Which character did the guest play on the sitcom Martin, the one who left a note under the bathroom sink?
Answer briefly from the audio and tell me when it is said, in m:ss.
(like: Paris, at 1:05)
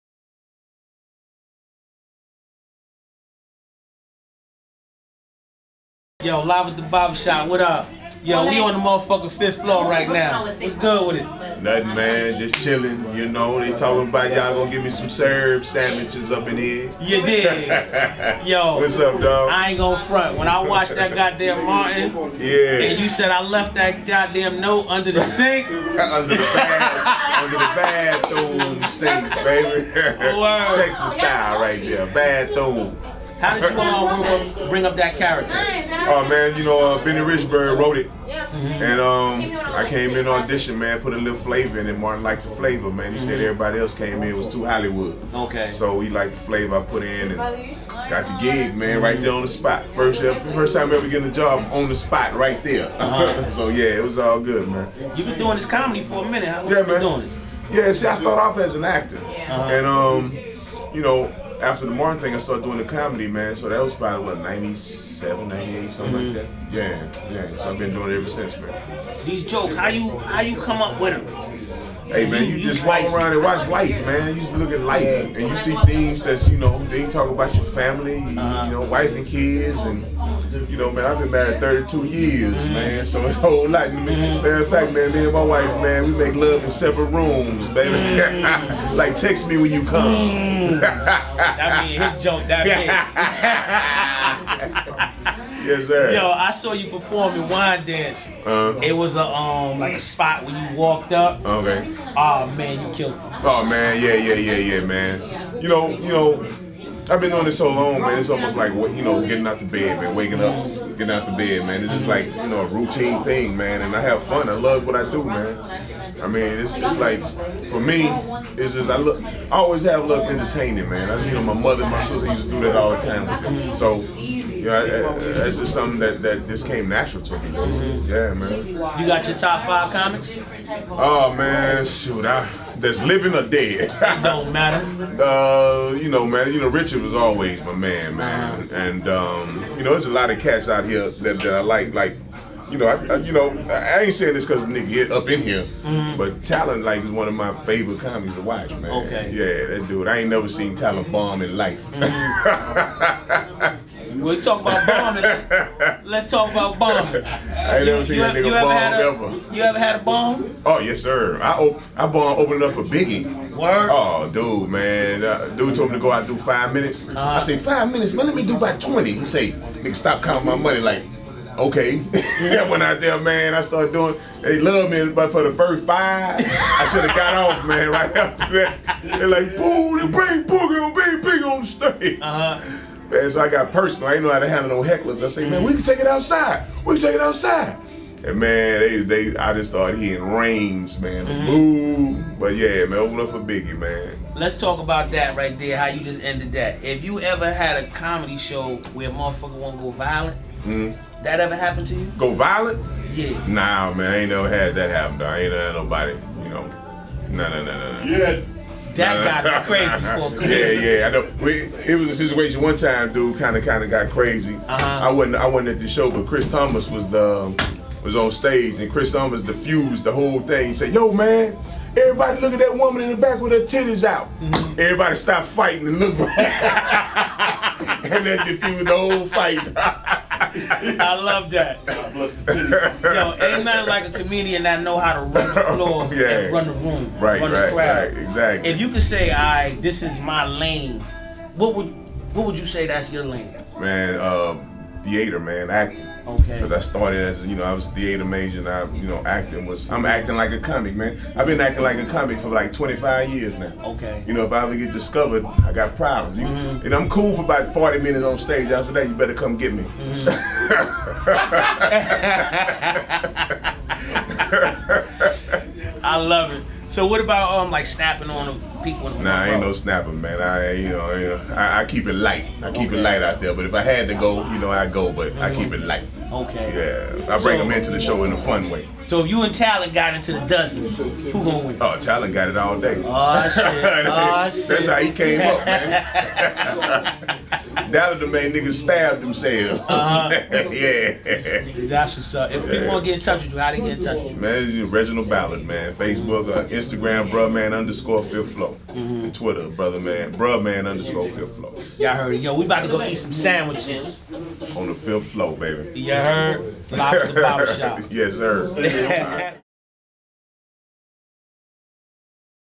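Benny Richburg, at 0:37.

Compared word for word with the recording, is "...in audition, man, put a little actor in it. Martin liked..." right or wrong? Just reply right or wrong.
wrong.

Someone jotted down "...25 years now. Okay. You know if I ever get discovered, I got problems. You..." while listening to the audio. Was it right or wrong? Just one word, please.
right.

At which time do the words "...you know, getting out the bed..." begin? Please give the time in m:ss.
1:48.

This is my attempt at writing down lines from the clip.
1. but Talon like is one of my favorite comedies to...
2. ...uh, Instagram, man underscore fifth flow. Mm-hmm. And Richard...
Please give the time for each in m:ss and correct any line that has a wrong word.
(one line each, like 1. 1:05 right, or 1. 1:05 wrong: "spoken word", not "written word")
1. 2:26 right
2. 4:56 wrong: "Twitter", not "Richard".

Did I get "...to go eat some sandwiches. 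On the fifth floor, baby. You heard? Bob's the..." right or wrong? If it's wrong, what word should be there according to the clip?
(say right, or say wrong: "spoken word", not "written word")
right.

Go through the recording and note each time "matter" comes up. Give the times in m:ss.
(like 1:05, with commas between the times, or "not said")
1:24, 2:14.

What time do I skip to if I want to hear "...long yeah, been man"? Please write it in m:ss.
0:56.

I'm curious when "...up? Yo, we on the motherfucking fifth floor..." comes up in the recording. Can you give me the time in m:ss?
0:07.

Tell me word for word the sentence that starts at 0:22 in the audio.
and you said I left that goddamn note under the sink.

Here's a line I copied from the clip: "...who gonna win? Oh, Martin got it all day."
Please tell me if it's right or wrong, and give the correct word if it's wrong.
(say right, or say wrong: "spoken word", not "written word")
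wrong: "Talon", not "Martin".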